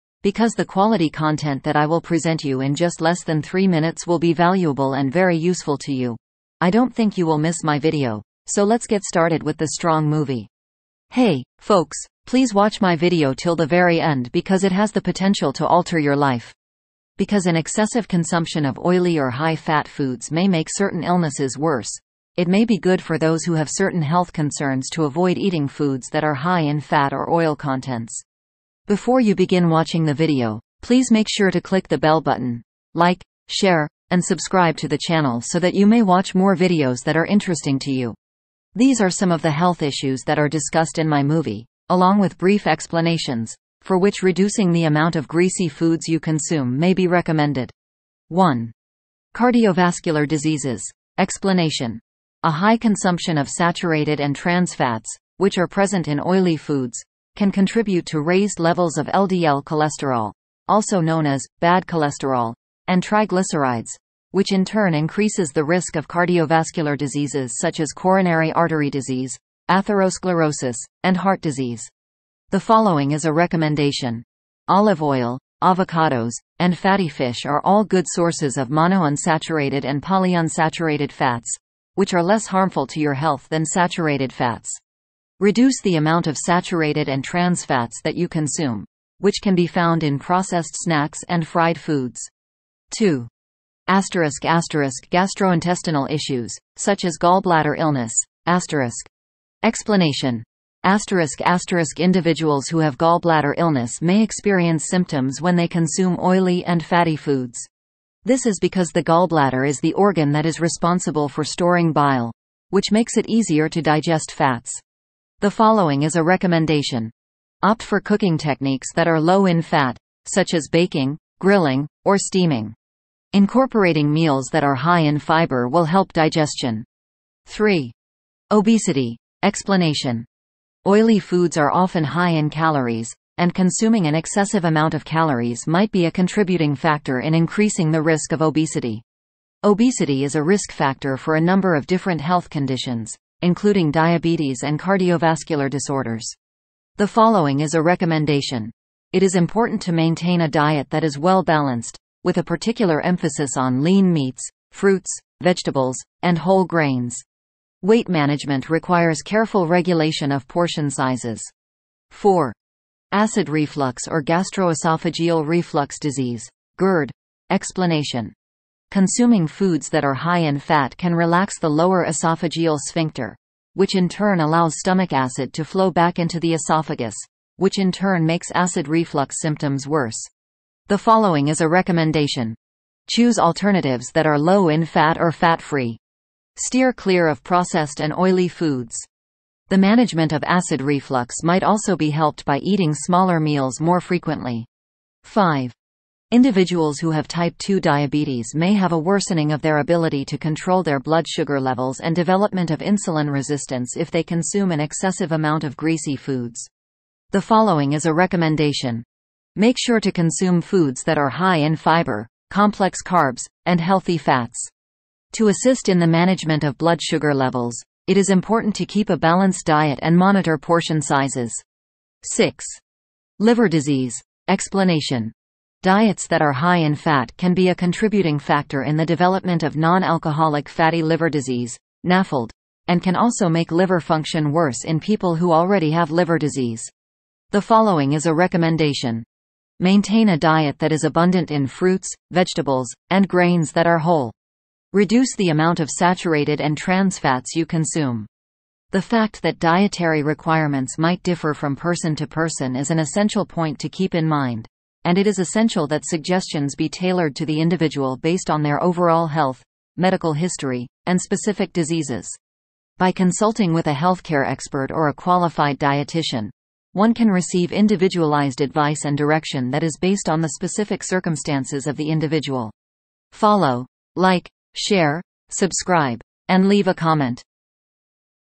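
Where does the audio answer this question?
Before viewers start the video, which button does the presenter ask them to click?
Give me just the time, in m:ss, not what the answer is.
0:31.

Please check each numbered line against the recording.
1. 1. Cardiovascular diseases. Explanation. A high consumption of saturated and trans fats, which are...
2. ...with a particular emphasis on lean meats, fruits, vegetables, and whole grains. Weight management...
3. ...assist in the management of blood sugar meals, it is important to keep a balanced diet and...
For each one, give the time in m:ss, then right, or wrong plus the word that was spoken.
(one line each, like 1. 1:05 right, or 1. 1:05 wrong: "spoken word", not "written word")
1. 0:48 right
2. 2:32 right
3. 3:35 wrong: "levels", not "meals".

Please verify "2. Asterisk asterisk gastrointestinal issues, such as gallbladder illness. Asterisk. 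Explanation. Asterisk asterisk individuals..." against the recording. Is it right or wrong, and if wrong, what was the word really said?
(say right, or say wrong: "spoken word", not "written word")
right.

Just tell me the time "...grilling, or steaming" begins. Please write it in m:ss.
2:01.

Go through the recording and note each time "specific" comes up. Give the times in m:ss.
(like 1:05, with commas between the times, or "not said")
4:21, 4:30.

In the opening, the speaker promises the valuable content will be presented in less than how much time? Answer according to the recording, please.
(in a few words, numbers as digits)
3 minutes.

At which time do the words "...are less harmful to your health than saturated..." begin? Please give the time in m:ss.
1:22.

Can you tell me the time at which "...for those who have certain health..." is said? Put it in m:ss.
0:23.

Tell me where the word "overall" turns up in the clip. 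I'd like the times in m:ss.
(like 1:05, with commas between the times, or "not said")
4:18.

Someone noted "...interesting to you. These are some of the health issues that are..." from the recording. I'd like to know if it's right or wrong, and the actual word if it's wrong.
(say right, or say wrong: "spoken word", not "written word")
right.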